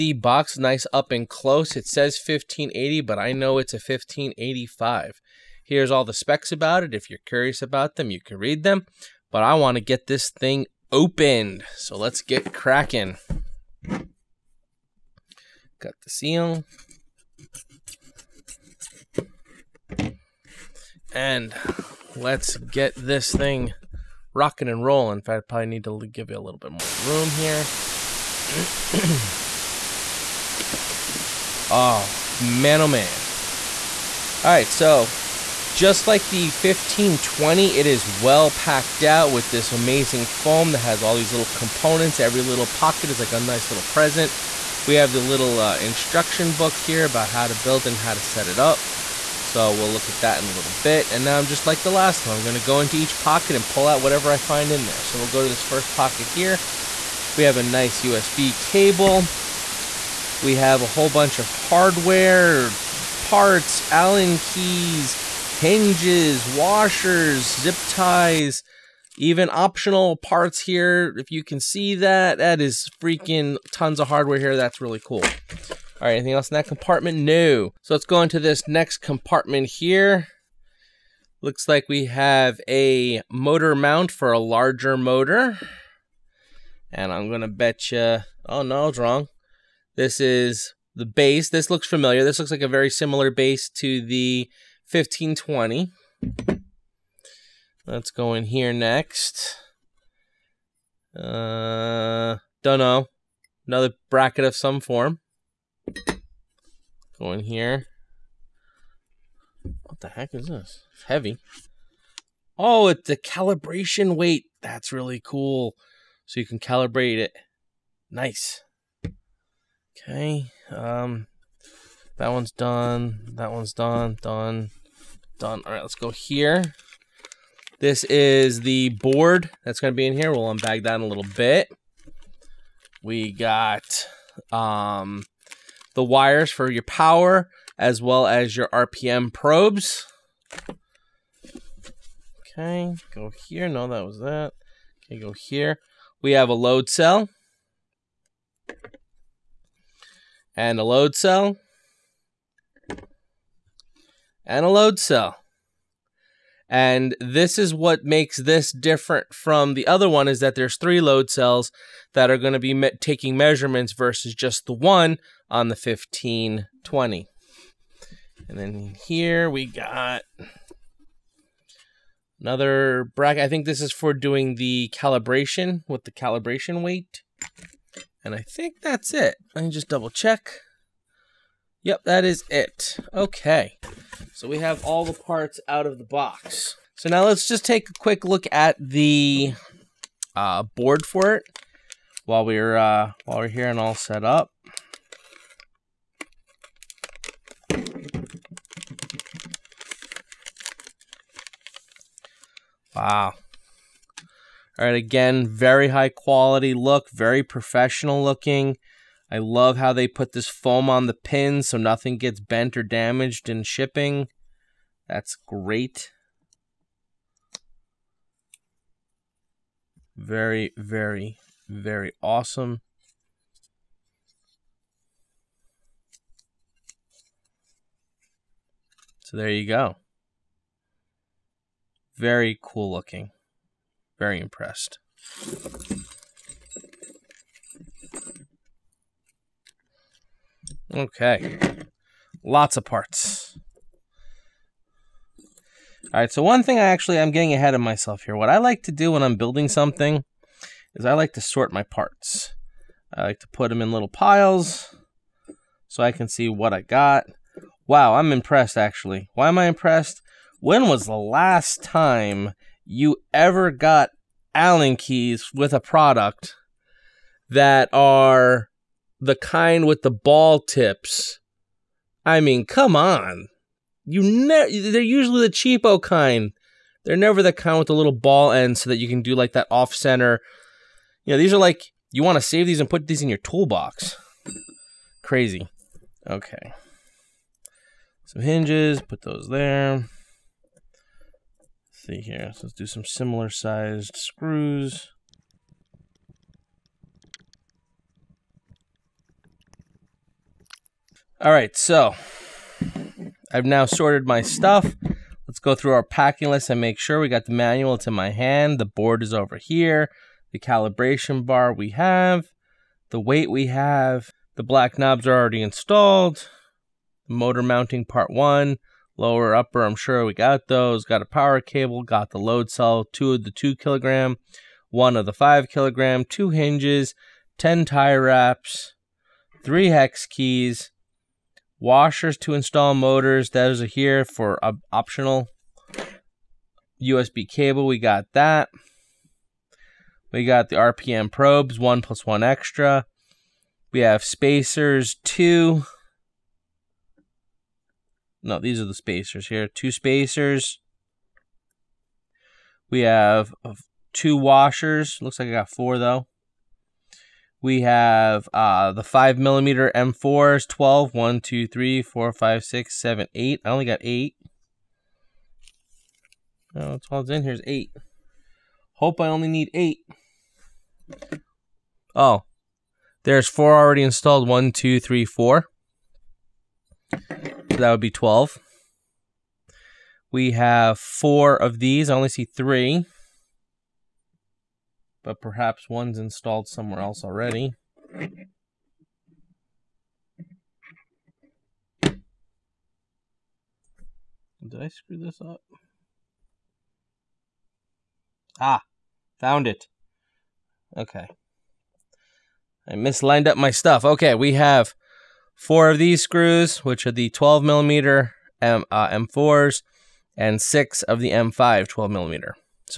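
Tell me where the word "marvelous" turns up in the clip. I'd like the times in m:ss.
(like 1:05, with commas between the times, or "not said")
not said.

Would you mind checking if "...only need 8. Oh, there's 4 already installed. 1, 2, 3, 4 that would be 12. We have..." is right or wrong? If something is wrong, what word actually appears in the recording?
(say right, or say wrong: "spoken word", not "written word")
right.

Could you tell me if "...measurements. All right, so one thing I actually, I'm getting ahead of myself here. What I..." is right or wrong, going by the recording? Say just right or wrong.
wrong.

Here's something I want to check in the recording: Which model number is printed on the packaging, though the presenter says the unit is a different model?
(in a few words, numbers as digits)
1580.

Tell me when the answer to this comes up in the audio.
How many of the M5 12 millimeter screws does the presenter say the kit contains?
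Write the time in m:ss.
6:50.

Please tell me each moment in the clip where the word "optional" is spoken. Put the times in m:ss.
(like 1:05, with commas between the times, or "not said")
1:09, 5:34.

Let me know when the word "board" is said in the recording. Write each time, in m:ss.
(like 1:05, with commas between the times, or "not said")
2:08, 3:10, 5:08.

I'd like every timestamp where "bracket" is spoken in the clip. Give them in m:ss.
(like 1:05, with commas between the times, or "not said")
1:44, 2:53.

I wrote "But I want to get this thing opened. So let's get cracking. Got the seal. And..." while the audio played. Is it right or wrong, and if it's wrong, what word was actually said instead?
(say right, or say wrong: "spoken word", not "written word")
right.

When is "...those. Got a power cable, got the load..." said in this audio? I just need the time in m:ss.
5:20.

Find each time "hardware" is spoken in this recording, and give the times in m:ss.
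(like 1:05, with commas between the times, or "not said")
1:01, 1:14.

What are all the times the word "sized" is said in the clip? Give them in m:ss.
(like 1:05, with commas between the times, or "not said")
4:53.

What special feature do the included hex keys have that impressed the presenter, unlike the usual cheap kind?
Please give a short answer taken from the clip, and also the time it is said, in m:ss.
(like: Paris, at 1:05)
ball tips, at 4:30.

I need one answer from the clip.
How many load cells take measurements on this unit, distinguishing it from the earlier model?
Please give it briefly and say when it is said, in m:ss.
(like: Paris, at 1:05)
3, at 2:40.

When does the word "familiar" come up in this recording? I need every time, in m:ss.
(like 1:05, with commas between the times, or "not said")
1:31.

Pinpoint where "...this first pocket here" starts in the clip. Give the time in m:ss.
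0:55.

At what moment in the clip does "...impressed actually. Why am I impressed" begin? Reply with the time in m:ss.
4:18.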